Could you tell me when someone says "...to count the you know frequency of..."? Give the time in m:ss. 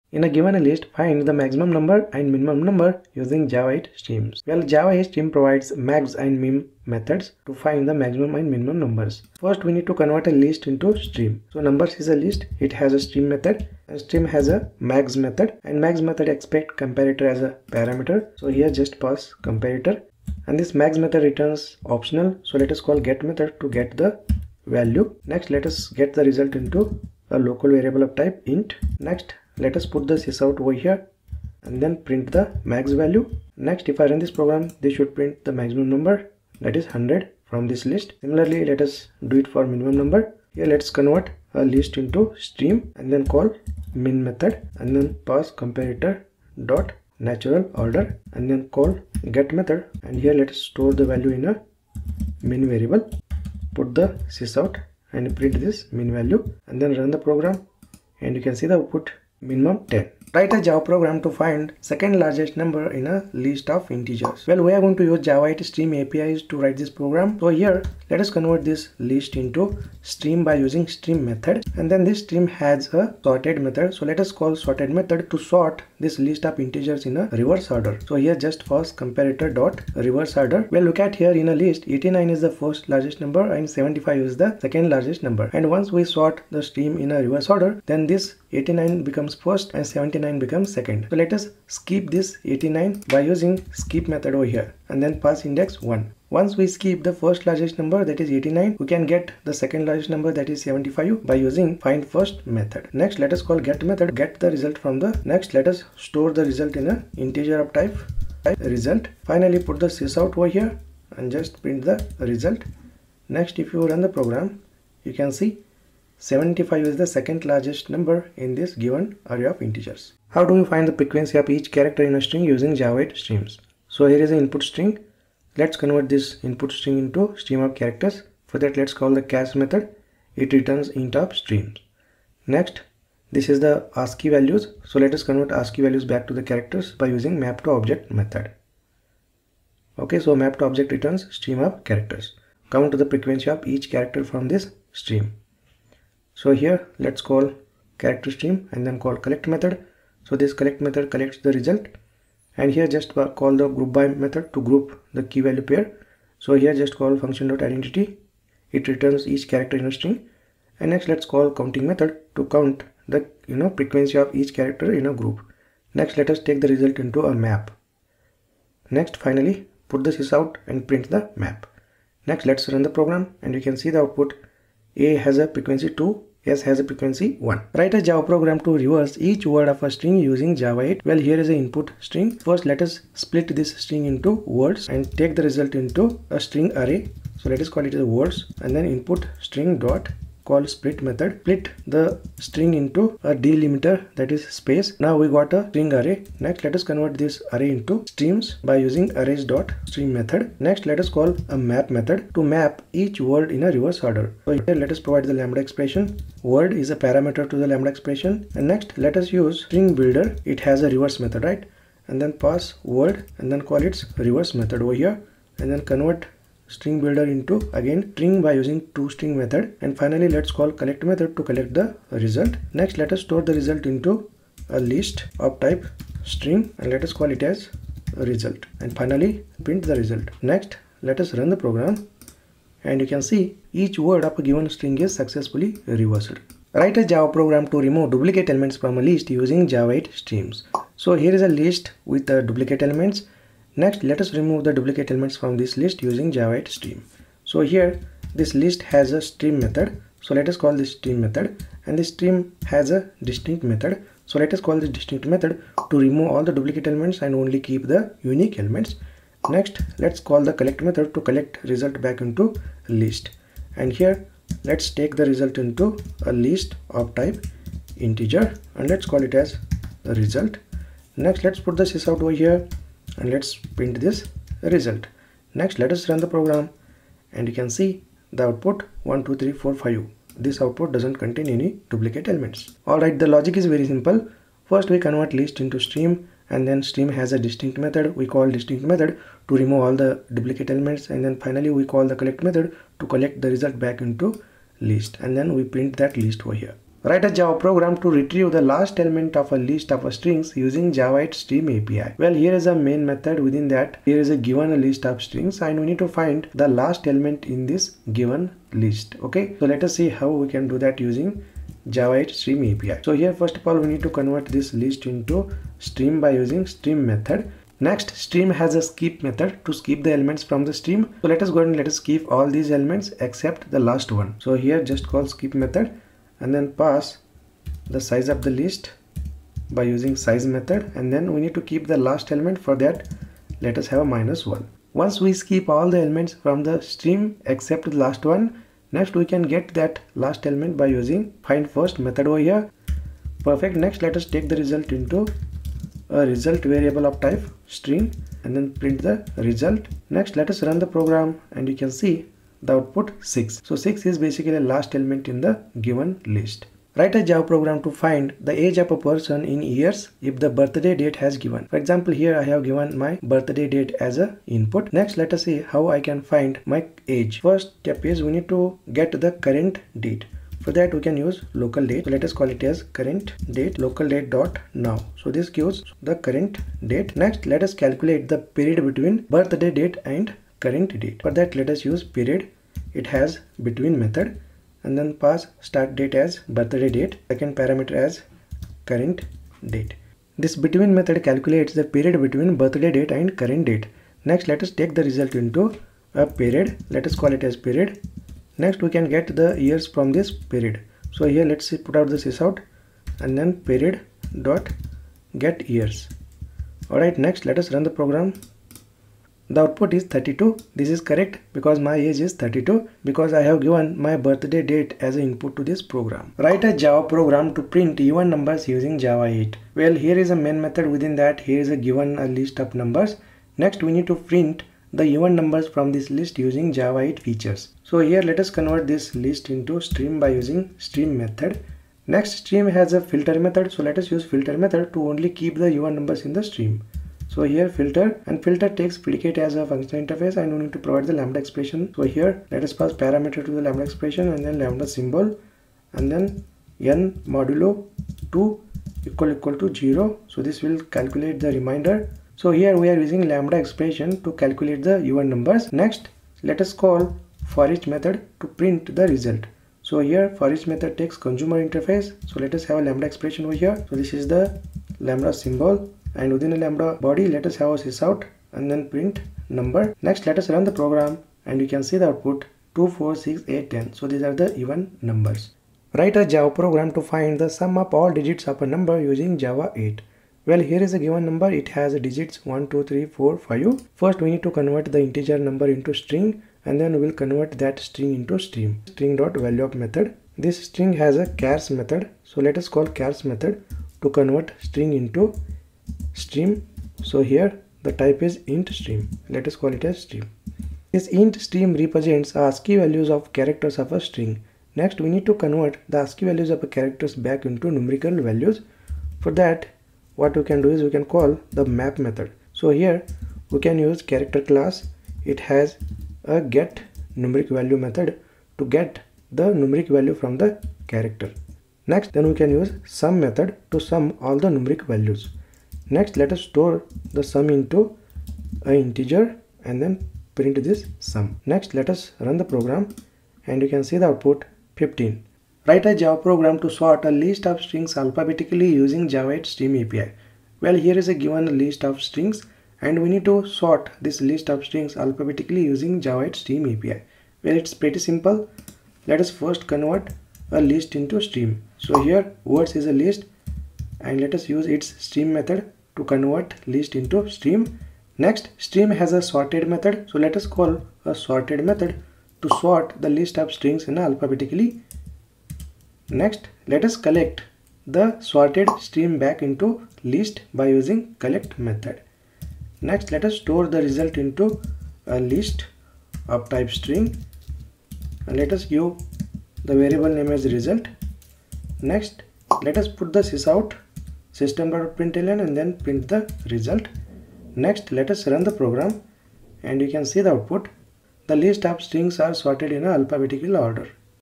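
2:42.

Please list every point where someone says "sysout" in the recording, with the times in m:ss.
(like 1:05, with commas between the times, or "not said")
0:30, 0:54, 1:49, 4:31, 6:42, 7:47.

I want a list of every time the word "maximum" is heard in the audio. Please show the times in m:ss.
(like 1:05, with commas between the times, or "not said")
0:01, 0:07, 0:35.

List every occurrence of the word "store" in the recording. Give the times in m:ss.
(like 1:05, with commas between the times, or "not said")
0:50, 1:45, 3:43, 8:46, 9:33.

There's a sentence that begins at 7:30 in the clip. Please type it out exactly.
So this will calculate the remainder.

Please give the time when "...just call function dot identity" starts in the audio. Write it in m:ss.
2:36.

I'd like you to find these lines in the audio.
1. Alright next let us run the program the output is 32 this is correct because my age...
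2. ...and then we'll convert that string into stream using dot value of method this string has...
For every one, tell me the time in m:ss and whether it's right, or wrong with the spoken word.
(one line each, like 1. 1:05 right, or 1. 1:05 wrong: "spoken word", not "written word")
1. 6:46 right
2. 8:06 wrong: "string", not "using".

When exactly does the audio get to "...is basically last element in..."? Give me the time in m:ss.
5:54.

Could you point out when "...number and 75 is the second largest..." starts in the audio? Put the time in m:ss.
1:23.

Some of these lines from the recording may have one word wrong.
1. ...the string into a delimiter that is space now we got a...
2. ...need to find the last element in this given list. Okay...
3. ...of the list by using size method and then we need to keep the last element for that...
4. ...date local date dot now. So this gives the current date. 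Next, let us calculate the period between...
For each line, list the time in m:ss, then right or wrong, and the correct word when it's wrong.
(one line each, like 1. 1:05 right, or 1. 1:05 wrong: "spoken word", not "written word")
1. 3:11 right
2. 5:05 right
3. 5:28 right
4. 6:13 right.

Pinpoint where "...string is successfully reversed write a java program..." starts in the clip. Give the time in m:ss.
3:54.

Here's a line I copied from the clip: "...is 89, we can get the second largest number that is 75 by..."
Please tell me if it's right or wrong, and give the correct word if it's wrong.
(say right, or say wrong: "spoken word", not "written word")
right.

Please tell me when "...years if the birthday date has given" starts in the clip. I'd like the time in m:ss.
5:59.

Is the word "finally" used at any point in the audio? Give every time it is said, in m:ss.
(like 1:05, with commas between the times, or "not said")
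1:49, 2:49, 3:40, 3:49, 4:51.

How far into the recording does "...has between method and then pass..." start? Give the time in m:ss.
6:23.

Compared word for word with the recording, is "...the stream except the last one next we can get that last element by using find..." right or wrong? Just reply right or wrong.
right.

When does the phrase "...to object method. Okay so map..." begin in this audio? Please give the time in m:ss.
2:17.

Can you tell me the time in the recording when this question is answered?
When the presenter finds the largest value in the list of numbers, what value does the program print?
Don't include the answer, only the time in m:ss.
0:36.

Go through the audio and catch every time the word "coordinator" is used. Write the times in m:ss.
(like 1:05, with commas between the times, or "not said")
not said.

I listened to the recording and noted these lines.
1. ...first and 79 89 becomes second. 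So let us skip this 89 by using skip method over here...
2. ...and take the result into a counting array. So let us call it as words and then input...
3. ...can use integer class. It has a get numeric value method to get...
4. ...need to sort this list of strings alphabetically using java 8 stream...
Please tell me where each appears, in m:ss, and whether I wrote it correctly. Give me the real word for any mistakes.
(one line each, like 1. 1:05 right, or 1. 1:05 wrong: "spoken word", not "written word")
1. 1:29 right
2. 3:04 wrong: "string", not "counting"
3. 8:33 wrong: "character", not "integer"
4. 9:03 right.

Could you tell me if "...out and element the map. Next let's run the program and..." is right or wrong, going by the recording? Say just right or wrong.
wrong.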